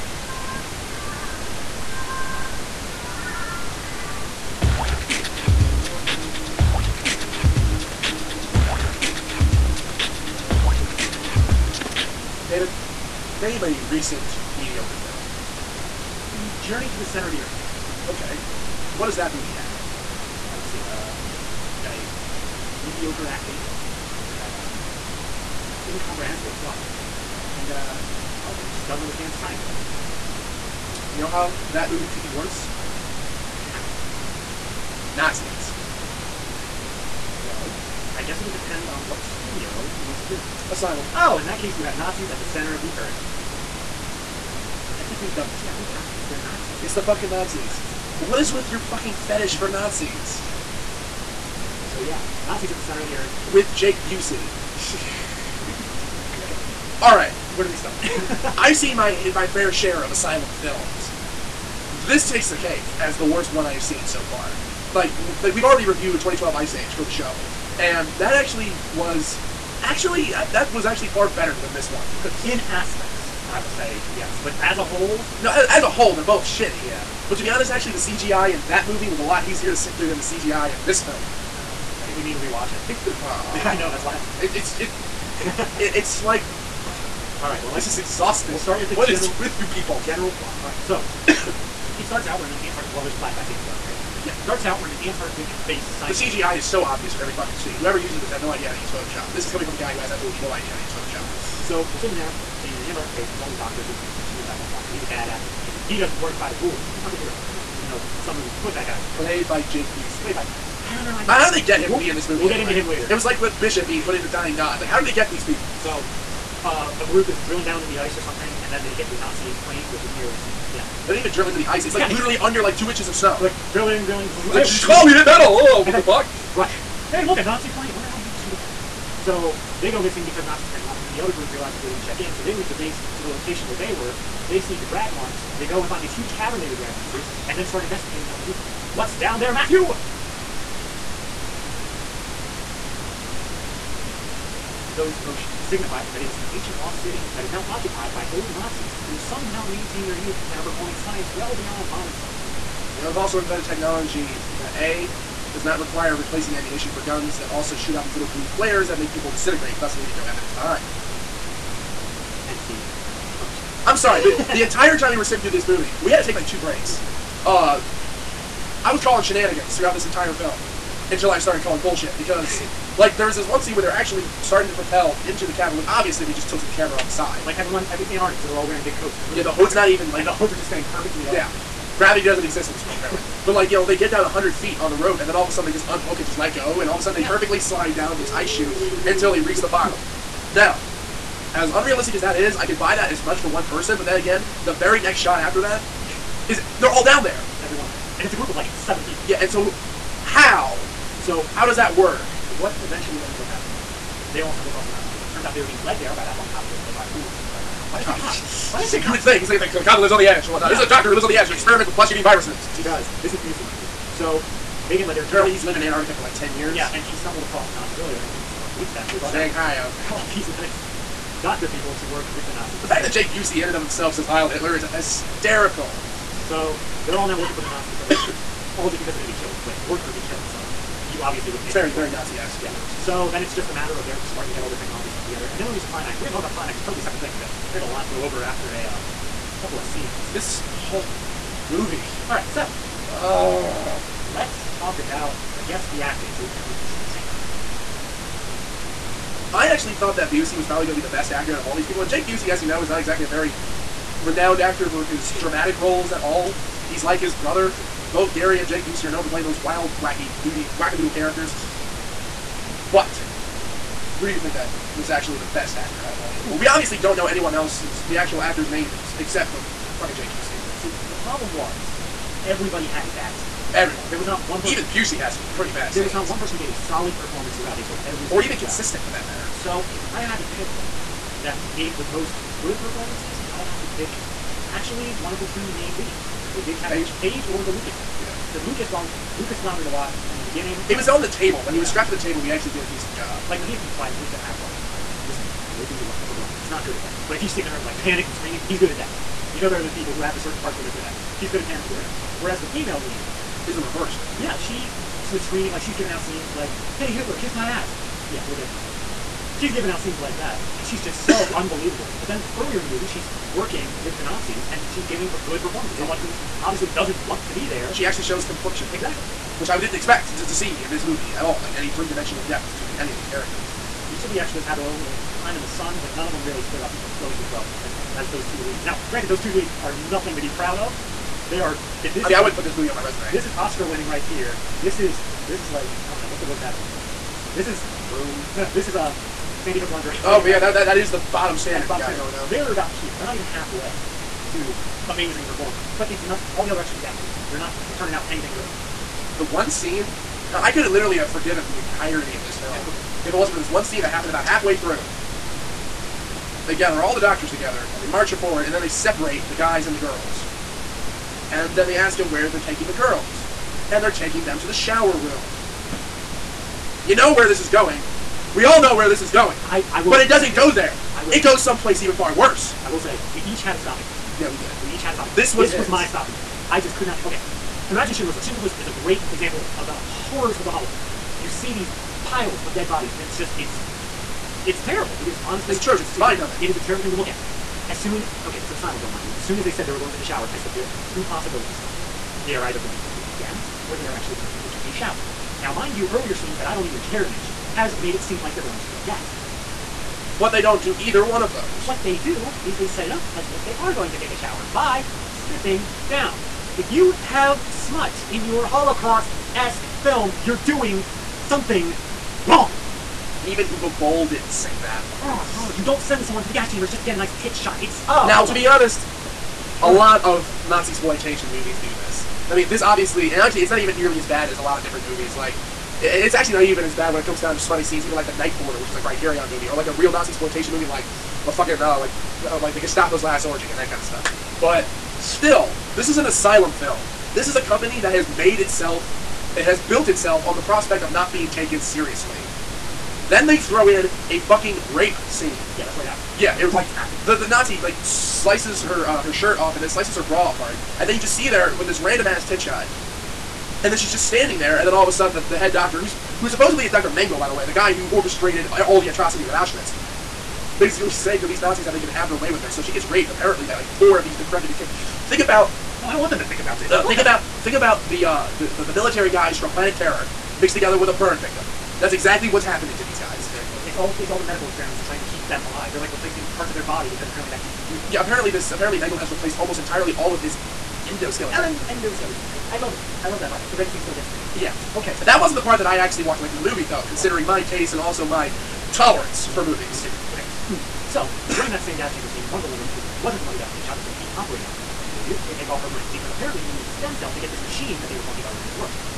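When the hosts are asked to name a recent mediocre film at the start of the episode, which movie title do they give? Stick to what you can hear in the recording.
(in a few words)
Journey to the Center of the Earth.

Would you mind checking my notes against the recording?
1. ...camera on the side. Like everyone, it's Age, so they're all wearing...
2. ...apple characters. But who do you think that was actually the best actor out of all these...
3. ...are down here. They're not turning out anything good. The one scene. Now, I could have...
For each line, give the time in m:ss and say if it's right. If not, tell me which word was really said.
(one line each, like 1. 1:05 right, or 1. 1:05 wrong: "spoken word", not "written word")
1. 2:56 wrong: "Antarctic", not "Age"
2. 4:20 wrong: "wackadoodle", not "apple"
3. 5:46 right.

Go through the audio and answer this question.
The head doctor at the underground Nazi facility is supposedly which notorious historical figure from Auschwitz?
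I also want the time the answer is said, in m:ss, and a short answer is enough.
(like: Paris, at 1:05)
Dr. Mengele, at 7:36.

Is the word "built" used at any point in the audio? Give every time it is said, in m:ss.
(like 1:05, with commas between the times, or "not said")
7:19.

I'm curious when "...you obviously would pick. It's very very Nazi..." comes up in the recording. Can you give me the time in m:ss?
3:51.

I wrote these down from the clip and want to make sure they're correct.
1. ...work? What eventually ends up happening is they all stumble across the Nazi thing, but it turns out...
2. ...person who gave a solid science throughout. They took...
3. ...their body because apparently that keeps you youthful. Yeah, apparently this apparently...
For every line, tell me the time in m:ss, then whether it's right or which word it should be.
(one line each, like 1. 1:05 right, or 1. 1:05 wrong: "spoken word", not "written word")
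1. 3:21 right
2. 4:36 wrong: "performance", not "science"
3. 7:56 right.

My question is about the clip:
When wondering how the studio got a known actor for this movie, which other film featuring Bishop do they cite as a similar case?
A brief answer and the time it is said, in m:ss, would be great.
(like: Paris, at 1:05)
Dying God, at 1:54.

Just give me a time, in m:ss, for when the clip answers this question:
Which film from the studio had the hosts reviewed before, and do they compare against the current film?
1:06.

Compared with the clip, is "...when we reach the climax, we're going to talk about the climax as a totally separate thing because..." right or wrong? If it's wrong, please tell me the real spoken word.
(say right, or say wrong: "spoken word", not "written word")
right.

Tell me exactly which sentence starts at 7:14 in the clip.
But still, this is an asylum film.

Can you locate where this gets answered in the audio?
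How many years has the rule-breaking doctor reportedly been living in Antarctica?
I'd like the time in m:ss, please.
3:36.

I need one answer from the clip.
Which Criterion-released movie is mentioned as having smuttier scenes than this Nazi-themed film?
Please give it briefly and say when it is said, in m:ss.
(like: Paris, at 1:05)
The Night Porter, at 7:08.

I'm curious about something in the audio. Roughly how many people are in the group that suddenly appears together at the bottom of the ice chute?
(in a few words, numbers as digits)
7.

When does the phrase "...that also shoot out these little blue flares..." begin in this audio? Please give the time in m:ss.
2:37.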